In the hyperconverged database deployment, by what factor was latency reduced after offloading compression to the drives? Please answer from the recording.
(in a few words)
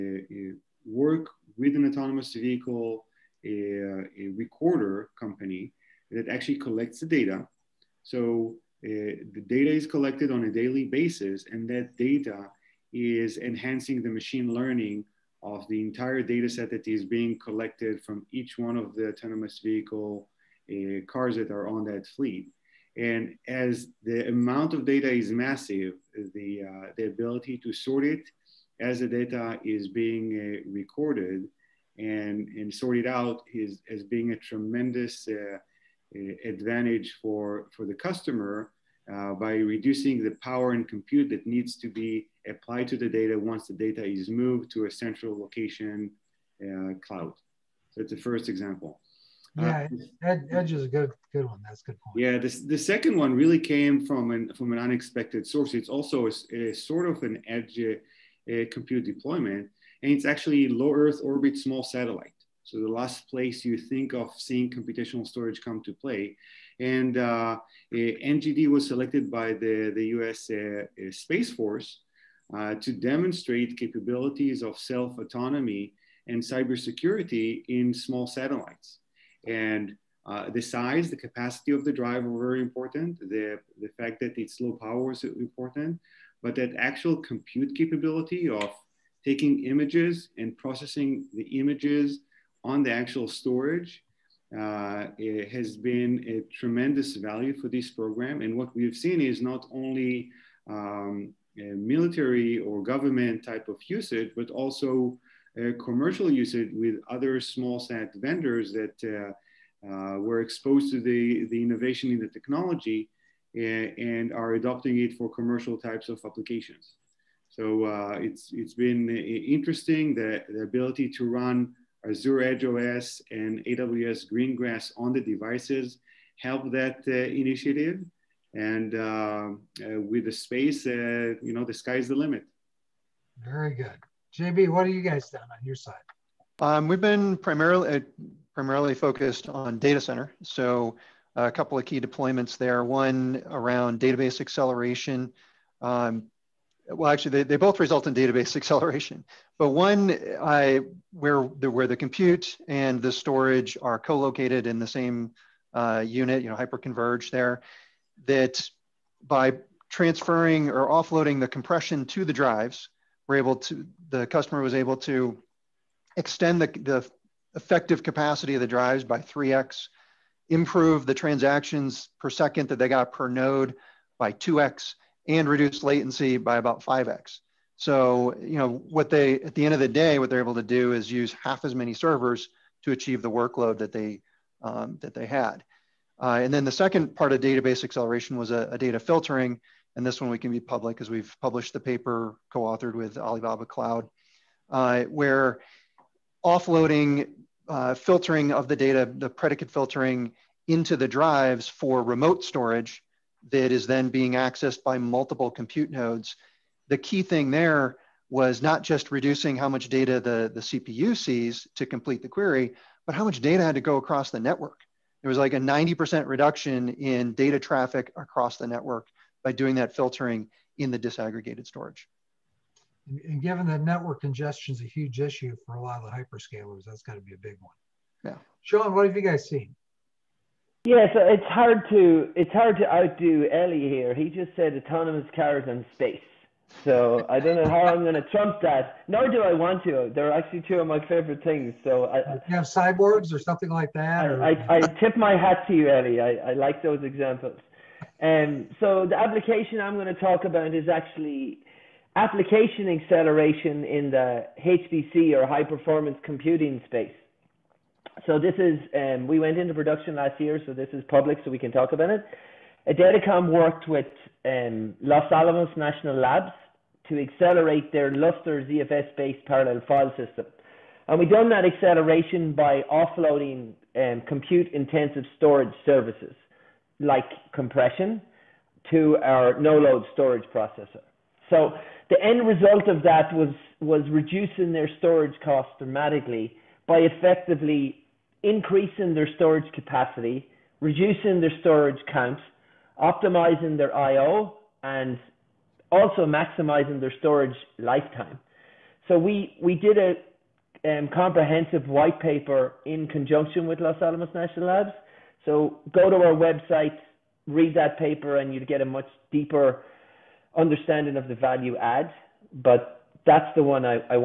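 5x.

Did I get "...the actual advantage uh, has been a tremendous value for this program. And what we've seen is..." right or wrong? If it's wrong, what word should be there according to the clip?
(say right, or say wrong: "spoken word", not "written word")
wrong: "storage", not "advantage".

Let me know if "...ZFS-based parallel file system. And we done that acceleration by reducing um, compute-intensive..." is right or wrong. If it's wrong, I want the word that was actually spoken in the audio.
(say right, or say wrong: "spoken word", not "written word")
wrong: "offloading", not "reducing".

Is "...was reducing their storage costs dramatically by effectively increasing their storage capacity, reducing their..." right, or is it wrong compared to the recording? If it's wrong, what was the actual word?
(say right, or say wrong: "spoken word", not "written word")
right.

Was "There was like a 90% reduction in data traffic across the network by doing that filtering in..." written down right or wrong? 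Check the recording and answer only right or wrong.
right.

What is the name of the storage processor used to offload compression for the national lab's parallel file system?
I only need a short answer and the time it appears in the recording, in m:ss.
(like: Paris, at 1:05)
NoLoad, at 4:39.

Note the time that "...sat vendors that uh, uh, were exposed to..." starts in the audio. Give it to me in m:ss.
1:47.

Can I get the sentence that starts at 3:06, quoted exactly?
Uh, and then the second part of database acceleration was a, a, data filtering.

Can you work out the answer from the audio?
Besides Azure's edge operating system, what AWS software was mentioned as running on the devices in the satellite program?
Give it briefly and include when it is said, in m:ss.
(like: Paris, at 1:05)
AWS Greengrass, at 2:03.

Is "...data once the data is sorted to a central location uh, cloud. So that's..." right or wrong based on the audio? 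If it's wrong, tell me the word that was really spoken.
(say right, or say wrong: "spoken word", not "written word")
wrong: "moved", not "sorted".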